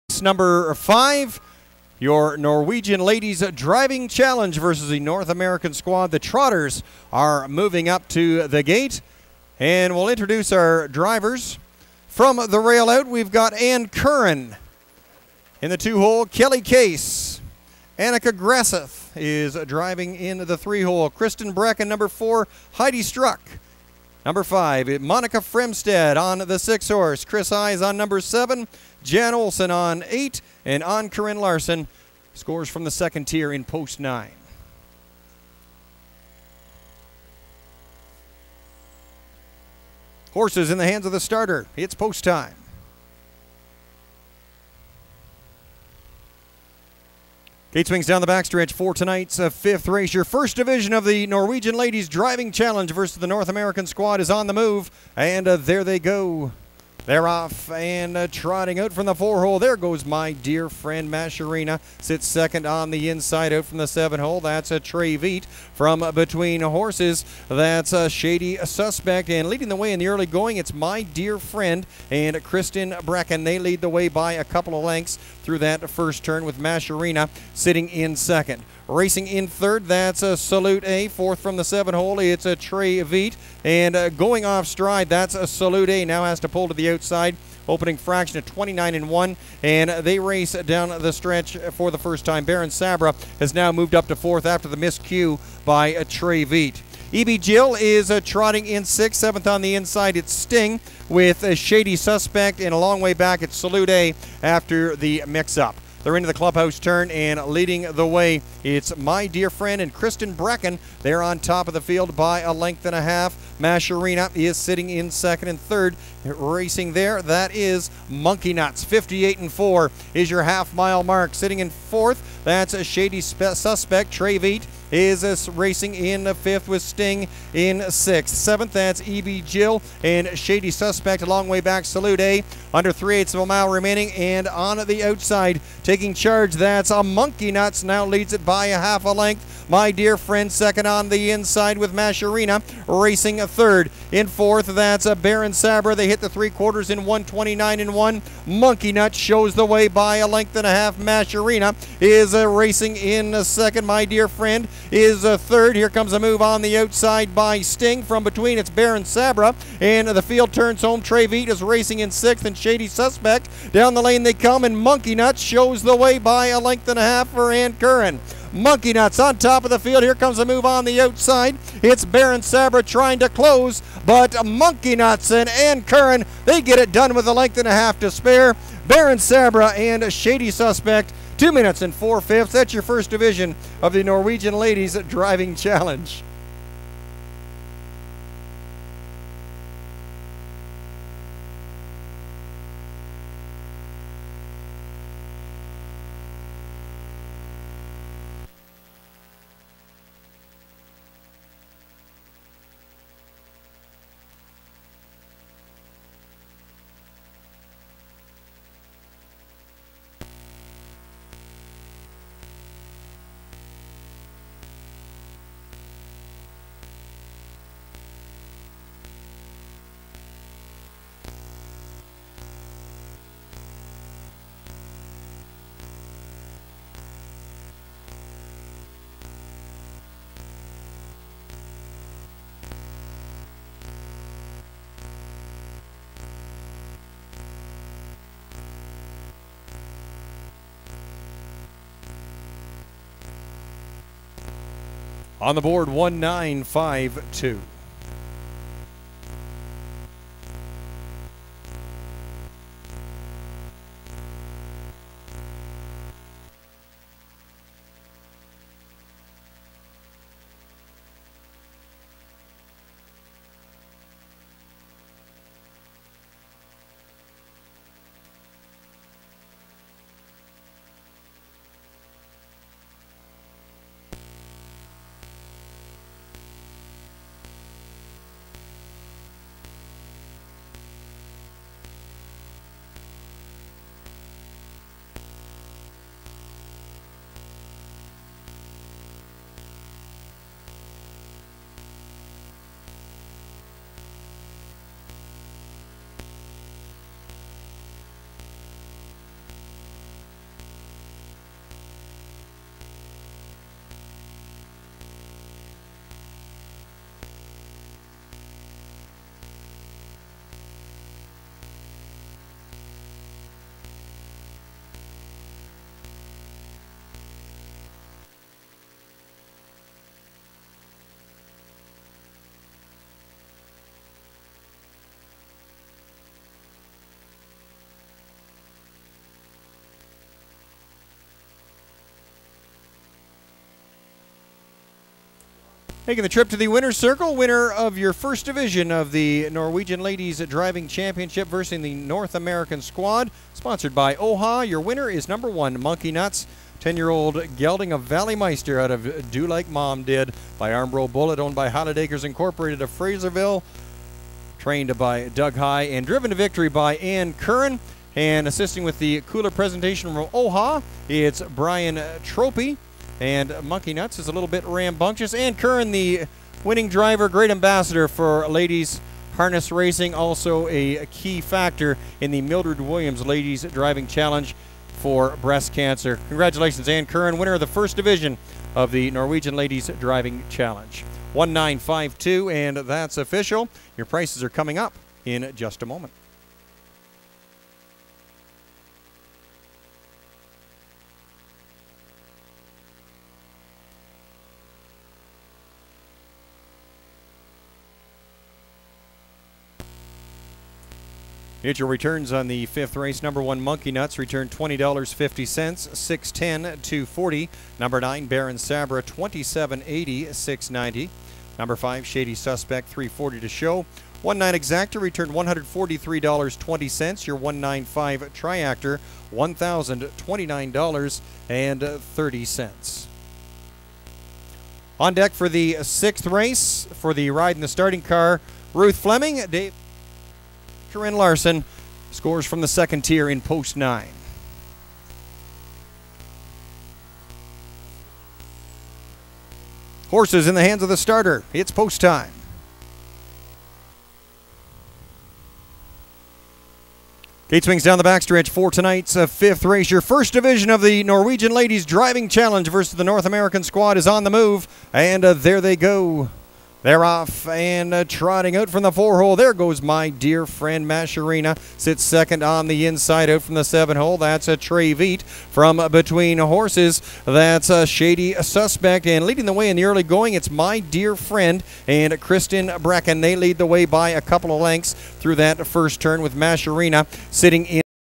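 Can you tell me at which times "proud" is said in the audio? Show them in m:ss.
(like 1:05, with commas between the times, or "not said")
not said.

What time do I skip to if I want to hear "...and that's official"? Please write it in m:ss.
6:22.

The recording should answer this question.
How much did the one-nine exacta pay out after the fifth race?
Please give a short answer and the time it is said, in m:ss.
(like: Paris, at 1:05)
$143.20, at 6:55.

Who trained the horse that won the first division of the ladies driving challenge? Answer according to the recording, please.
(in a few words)
Doug Hie.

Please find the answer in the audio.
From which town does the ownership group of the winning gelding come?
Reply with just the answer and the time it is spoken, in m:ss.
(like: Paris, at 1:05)
Fraserville, at 5:52.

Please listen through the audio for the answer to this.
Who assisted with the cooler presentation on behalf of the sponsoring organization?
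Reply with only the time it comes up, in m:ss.
6:01.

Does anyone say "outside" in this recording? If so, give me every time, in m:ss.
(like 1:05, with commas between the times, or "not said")
1:26, 2:15, 2:36, 2:50.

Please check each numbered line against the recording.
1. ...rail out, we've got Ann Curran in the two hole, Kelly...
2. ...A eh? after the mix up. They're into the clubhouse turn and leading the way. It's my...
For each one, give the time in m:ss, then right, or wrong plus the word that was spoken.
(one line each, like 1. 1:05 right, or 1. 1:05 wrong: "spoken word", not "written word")
1. 0:12 right
2. 1:43 right.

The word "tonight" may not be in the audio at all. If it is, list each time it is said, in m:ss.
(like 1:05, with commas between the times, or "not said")
0:48, 7:28.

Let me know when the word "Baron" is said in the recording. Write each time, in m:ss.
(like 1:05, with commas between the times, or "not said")
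1:32, 2:25, 2:38, 2:52, 2:58, 6:48.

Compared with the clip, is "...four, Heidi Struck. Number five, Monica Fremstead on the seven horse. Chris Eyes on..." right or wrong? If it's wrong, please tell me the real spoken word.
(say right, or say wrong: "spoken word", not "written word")
wrong: "six", not "seven".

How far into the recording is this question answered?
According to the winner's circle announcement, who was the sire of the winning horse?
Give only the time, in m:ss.
5:48.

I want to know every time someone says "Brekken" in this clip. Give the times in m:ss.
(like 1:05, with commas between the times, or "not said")
1:13, 1:50, 7:52.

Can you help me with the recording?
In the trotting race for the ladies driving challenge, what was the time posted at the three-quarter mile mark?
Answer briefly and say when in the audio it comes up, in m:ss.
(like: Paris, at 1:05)
1:29.1, at 2:27.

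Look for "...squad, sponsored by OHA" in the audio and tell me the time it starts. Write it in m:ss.
5:42.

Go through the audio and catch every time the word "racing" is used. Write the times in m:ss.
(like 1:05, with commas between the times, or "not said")
1:18, 1:56, 2:05, 2:22, 2:32, 2:41, 6:09.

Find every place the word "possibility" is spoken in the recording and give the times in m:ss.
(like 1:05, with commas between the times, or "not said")
not said.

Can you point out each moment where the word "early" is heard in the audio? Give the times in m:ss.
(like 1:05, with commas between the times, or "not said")
1:10, 7:49.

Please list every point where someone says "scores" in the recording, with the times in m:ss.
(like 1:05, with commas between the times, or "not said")
0:32, 7:12.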